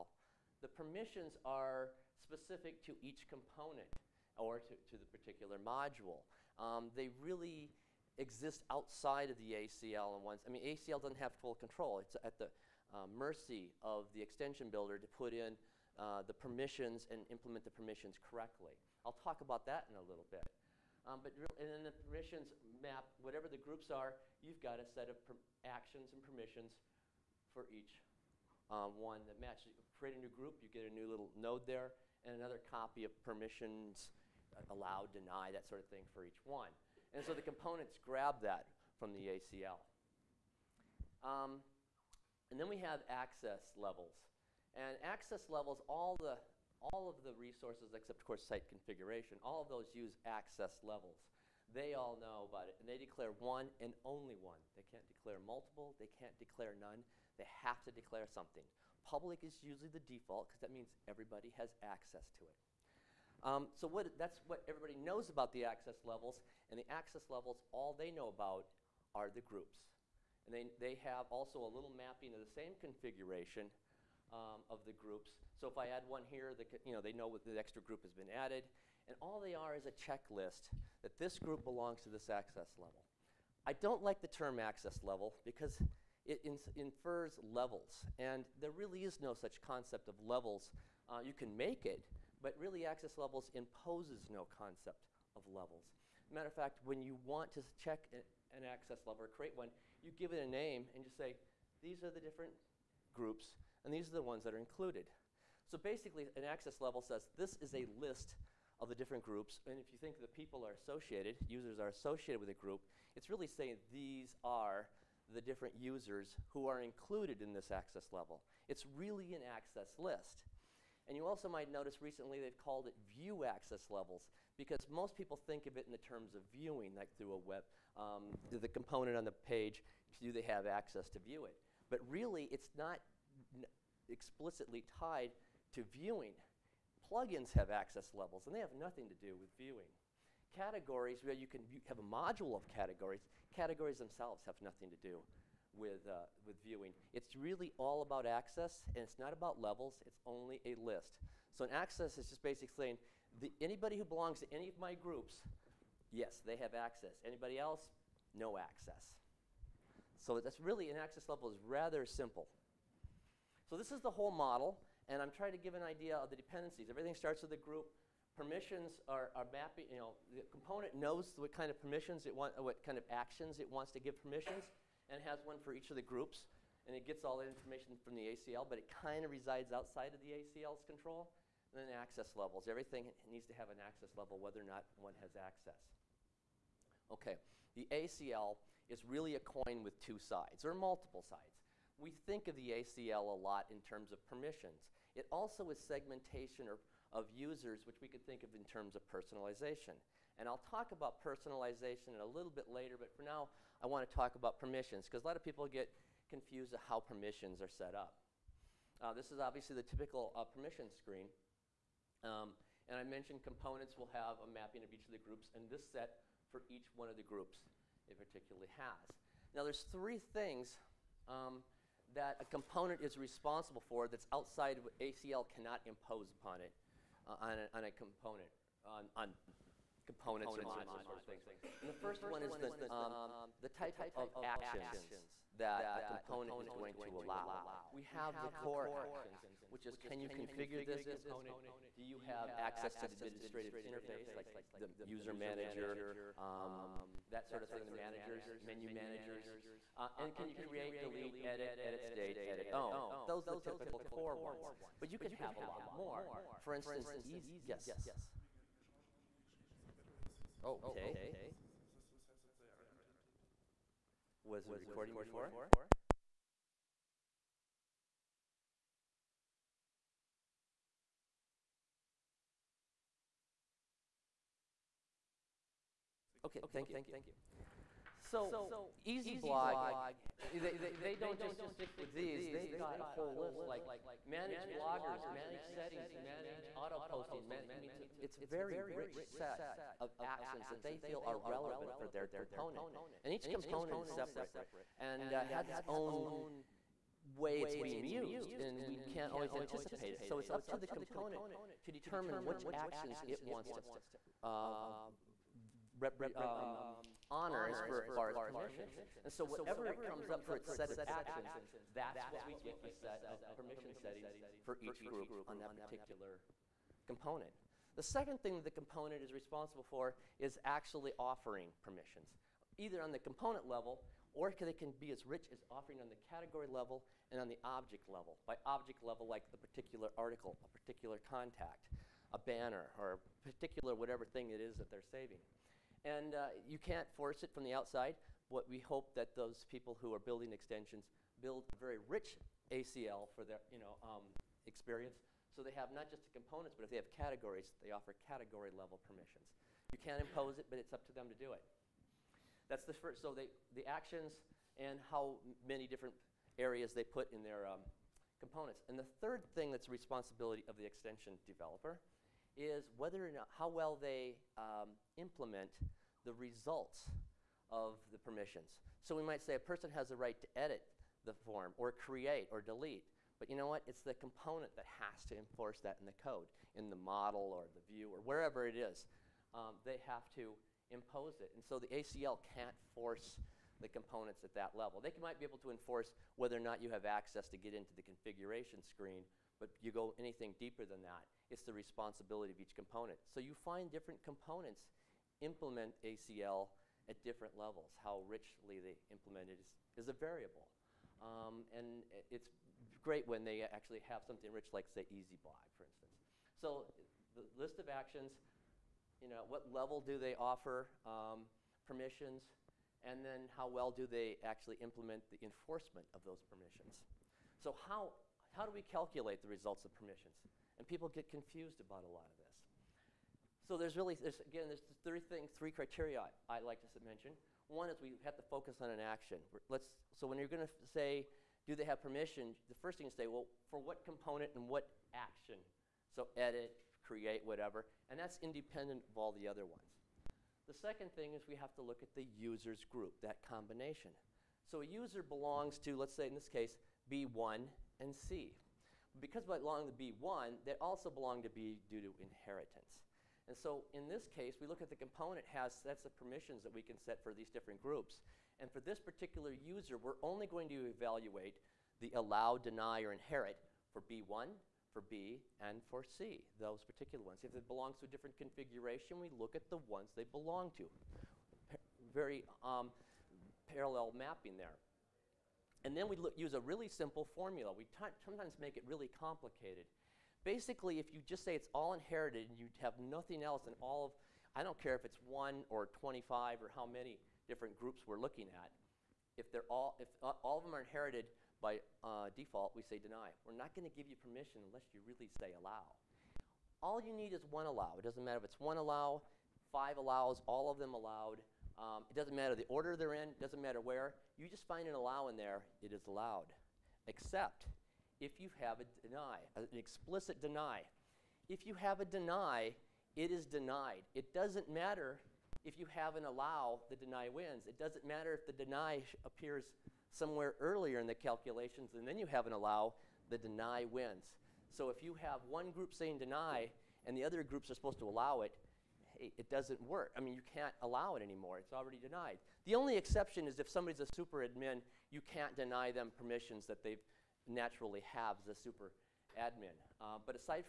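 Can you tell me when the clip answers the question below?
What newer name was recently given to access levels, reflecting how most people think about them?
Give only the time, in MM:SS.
02:03.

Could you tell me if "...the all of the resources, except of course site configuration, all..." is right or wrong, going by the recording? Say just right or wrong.
right.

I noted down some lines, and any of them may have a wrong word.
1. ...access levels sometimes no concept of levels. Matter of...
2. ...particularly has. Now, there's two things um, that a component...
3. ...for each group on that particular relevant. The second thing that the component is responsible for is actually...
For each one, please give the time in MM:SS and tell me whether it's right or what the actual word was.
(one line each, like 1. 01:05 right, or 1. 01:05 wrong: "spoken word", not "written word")
1. 01:32 wrong: "imposes", not "sometimes"
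2. 03:38 wrong: "three", not "two"
3. 05:14 wrong: "component", not "relevant".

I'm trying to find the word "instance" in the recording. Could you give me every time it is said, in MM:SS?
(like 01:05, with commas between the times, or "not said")
04:16, 06:45.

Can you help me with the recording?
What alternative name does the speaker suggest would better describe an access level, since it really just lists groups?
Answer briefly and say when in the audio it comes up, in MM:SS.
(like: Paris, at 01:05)
access list, at 01:59.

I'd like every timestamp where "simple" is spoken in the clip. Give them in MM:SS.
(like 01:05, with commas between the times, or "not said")
02:42, 07:56.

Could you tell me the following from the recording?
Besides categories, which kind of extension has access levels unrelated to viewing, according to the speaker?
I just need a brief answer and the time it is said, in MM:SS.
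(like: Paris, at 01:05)
Plugins, at 02:17.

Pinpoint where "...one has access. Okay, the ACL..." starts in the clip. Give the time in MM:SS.
03:05.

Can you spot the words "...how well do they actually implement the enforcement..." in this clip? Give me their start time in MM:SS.
06:53.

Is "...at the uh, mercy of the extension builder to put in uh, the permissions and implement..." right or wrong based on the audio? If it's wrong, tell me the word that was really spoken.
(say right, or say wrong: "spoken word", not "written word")
right.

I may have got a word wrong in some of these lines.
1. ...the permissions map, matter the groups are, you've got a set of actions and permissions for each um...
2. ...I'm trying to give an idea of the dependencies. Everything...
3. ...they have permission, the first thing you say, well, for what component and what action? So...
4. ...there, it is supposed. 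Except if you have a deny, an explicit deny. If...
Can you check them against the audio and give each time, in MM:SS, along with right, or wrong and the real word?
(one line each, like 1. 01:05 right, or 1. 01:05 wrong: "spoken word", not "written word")
1. 00:21 wrong: "whatever", not "matter"
2. 02:45 right
3. 07:11 right
4. 08:25 wrong: "allowed", not "supposed".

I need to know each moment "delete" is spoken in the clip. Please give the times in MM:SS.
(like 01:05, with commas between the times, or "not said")
04:11, 06:12.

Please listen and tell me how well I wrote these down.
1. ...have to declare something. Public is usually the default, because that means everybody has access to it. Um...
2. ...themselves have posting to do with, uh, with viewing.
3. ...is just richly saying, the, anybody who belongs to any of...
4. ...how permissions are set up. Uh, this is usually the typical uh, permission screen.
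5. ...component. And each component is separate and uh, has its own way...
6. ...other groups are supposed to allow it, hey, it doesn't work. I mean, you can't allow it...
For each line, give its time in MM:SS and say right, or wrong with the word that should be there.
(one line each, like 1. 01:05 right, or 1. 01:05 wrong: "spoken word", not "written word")
1. 00:57 right
2. 02:23 wrong: "nothing", not "posting"
3. 02:32 wrong: "basically", not "richly"
4. 03:26 wrong: "obviously", not "usually"
5. 04:52 right
6. 08:47 right.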